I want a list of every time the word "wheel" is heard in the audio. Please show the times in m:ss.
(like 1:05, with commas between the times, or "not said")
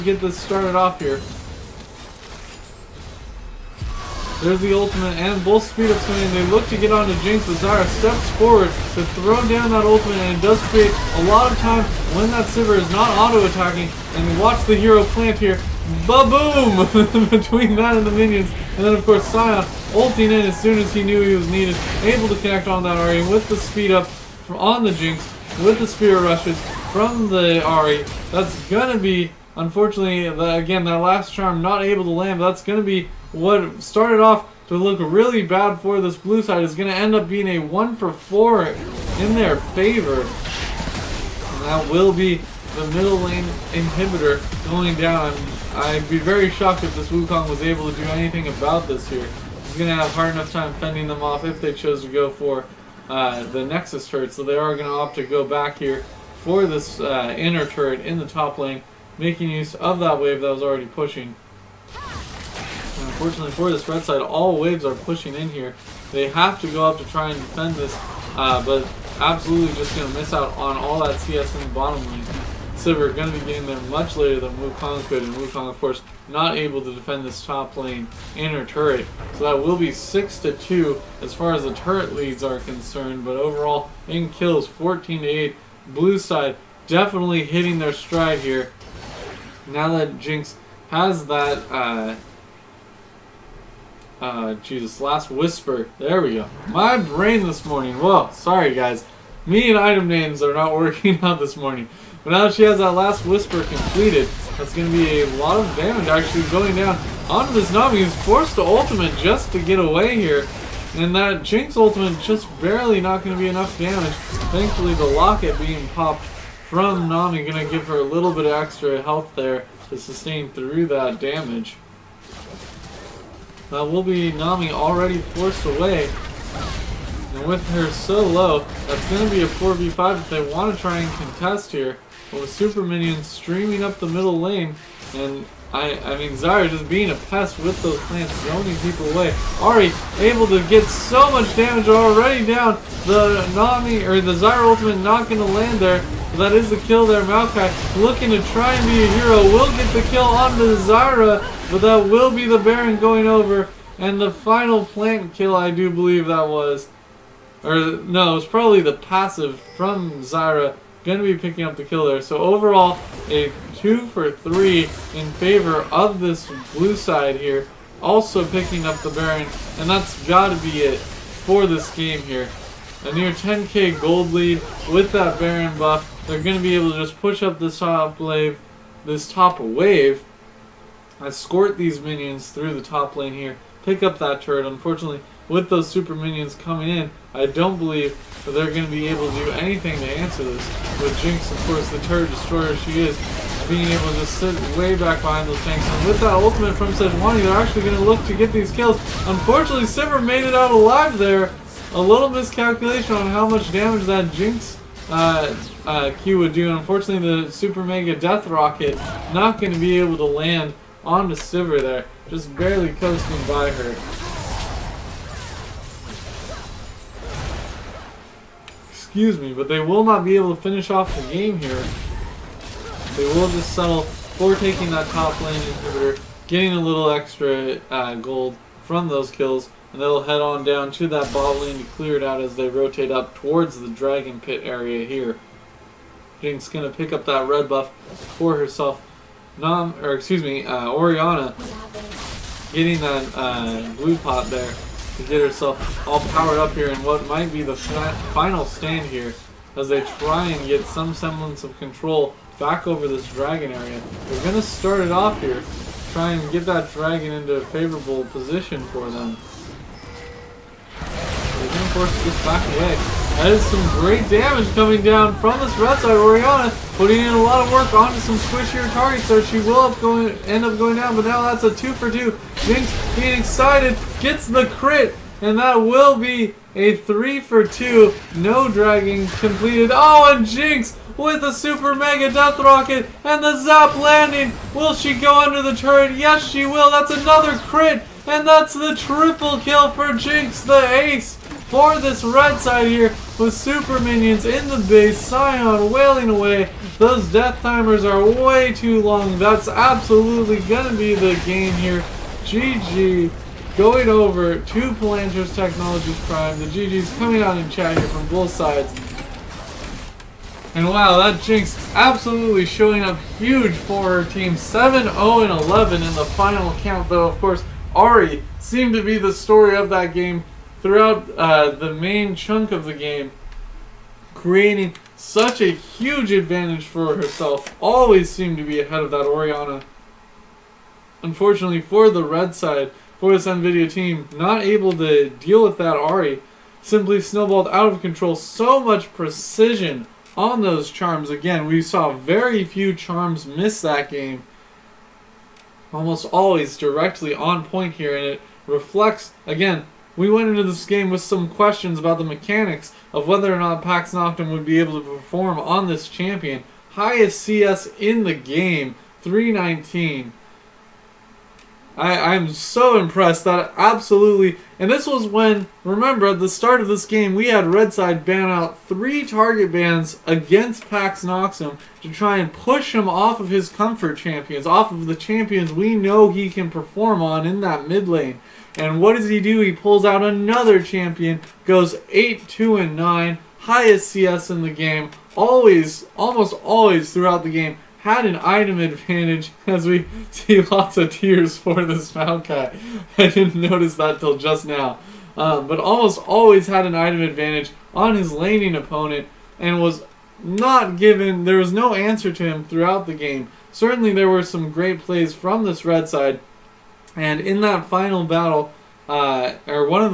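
not said.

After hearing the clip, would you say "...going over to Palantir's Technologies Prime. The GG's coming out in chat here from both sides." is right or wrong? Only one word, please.
right.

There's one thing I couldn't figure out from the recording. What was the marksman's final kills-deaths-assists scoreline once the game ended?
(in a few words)
7-0-11.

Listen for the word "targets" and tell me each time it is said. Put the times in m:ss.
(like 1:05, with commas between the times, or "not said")
4:28, 6:09.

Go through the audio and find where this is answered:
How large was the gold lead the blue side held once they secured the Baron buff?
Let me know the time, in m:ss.
2:53.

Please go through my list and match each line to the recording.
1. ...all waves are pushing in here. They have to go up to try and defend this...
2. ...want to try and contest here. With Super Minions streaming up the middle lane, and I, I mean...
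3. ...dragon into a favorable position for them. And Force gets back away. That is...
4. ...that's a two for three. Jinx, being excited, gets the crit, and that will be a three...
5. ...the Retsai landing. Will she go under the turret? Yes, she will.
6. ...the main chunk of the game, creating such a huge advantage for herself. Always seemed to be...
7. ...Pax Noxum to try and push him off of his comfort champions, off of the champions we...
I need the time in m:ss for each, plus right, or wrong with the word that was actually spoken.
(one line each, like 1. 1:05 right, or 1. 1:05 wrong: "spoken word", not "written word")
1. 1:04 right
2. 2:10 right
3. 4:16 right
4. 4:31 wrong: "two", not "three"
5. 4:43 wrong: "Zap", not "Retsai"
6. 5:21 right
7. 6:10 right.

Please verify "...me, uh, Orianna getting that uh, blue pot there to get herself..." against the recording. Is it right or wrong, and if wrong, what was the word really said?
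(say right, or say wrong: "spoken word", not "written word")
right.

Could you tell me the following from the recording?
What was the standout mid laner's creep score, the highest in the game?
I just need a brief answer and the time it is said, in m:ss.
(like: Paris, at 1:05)
319, at 5:59.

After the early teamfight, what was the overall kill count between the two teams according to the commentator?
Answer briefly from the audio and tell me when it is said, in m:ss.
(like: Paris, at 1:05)
14 to 8, at 1:24.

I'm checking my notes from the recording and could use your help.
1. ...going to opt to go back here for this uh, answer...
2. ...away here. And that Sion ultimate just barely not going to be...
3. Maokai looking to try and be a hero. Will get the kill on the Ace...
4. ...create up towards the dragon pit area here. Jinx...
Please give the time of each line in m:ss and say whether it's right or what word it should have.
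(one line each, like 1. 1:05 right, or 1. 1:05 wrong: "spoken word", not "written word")
1. 0:54 wrong: "inner", not "answer"
2. 1:49 wrong: "Jinx", not "Sion"
3. 2:27 wrong: "Zyra", not "Ace"
4. 3:52 wrong: "rotate", not "create".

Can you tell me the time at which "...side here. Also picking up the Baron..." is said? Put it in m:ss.
2:46.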